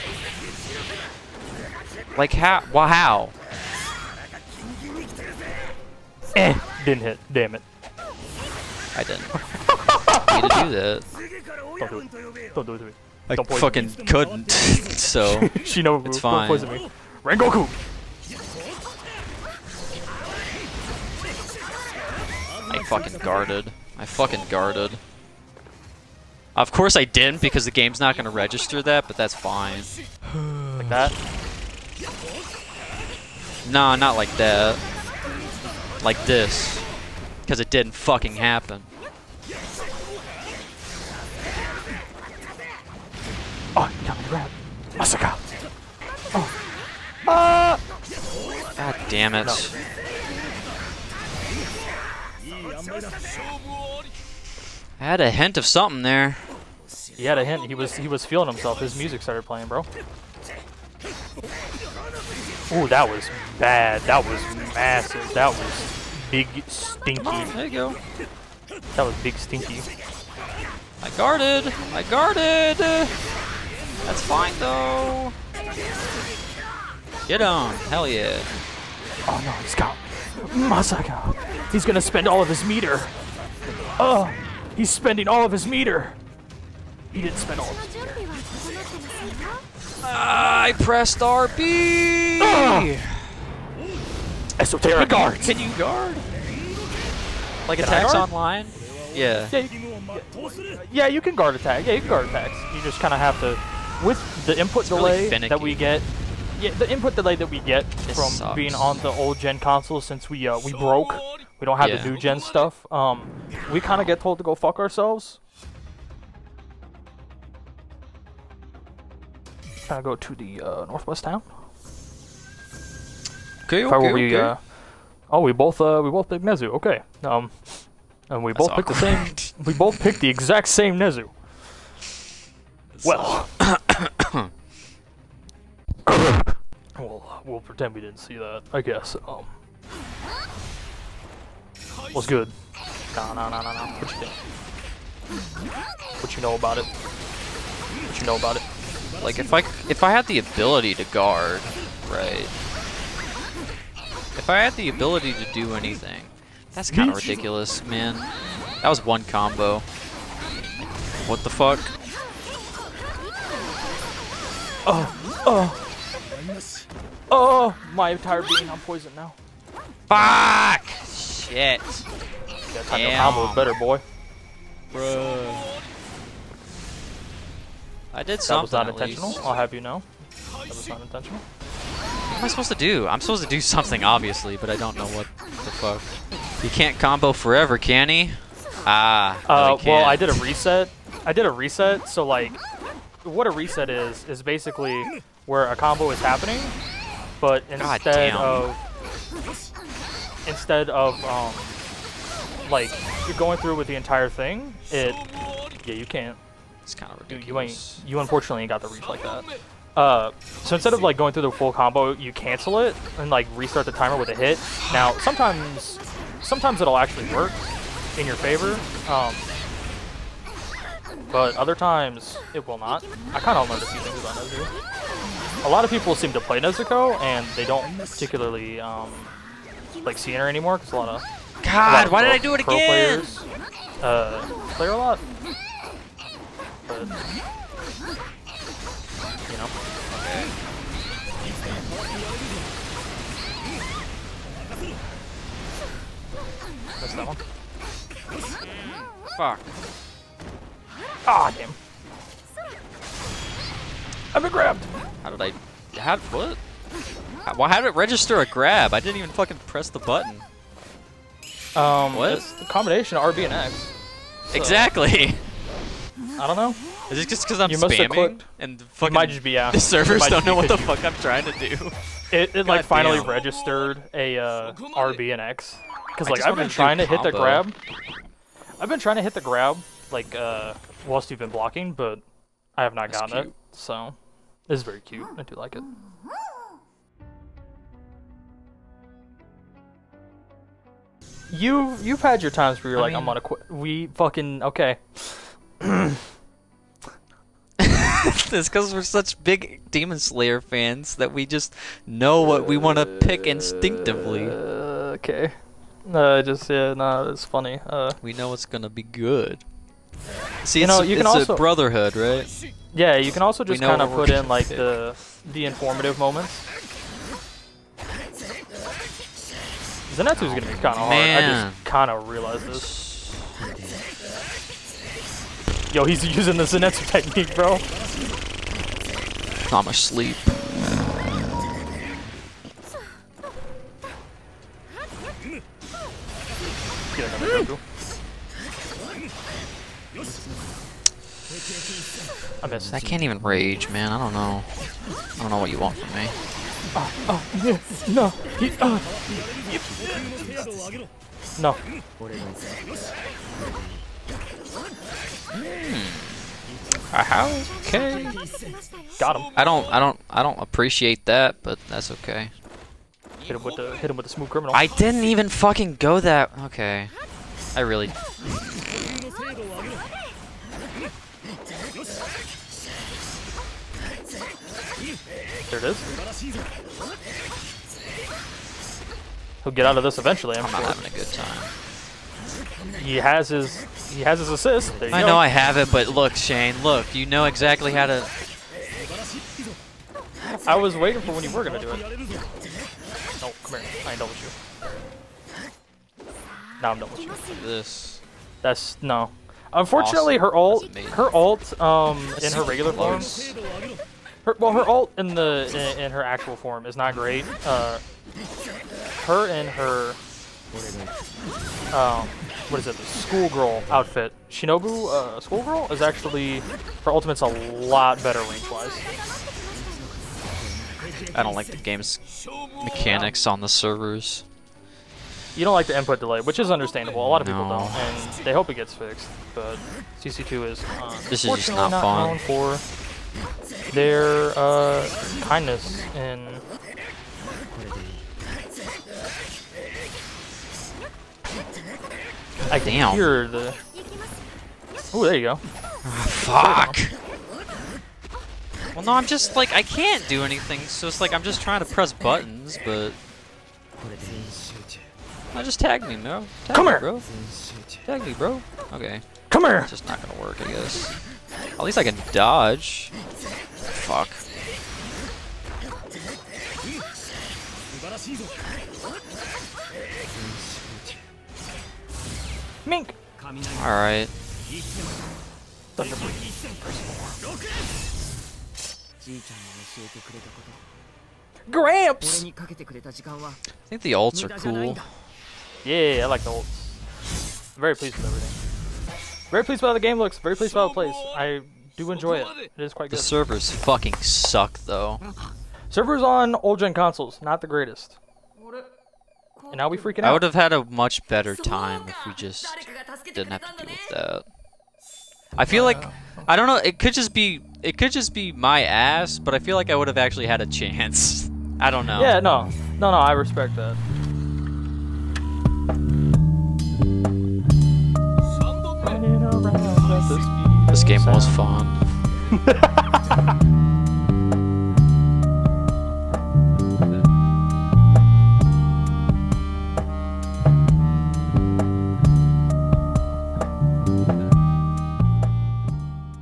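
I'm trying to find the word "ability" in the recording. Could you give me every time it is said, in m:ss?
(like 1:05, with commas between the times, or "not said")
2:30, 2:34.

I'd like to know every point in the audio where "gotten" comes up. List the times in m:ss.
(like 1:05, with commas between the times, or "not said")
4:43.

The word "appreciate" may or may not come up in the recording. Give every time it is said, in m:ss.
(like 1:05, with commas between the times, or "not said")
6:00.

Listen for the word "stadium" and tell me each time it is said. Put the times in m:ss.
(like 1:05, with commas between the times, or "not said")
not said.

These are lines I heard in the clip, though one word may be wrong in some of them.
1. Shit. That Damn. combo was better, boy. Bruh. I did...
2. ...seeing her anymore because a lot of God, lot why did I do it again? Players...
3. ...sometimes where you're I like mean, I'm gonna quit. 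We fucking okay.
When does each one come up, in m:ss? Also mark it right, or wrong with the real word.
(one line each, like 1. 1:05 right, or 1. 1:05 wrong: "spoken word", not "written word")
1. 2:51 right
2. 3:50 right
3. 4:52 wrong: "times", not "sometimes".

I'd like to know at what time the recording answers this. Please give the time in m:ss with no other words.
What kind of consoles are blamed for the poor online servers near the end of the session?
8:16.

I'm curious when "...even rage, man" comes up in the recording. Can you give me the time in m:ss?
5:43.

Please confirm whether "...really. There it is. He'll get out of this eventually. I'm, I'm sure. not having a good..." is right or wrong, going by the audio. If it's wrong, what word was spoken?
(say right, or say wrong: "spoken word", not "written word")
right.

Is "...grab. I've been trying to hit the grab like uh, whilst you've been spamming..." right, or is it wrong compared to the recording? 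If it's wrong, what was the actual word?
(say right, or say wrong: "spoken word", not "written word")
wrong: "blocking", not "spamming".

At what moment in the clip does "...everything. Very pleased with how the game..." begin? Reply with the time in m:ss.
8:08.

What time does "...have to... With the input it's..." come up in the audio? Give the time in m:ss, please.
1:43.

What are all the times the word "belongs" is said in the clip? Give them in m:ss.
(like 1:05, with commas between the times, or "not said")
not said.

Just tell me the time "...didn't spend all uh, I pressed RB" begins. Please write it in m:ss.
1:27.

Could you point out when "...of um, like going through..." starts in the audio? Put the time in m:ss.
3:20.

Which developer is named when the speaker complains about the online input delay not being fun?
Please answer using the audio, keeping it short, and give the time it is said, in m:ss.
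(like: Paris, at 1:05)
CC2, at 7:10.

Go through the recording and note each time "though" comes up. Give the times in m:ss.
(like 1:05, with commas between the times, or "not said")
1:14, 8:14.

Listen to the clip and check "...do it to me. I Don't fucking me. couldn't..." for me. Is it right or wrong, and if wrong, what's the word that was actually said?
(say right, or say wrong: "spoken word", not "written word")
right.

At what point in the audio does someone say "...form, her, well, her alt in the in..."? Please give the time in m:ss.
6:42.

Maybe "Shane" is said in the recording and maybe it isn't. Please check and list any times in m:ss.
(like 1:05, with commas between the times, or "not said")
6:26.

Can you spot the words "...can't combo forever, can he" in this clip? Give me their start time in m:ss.
3:06.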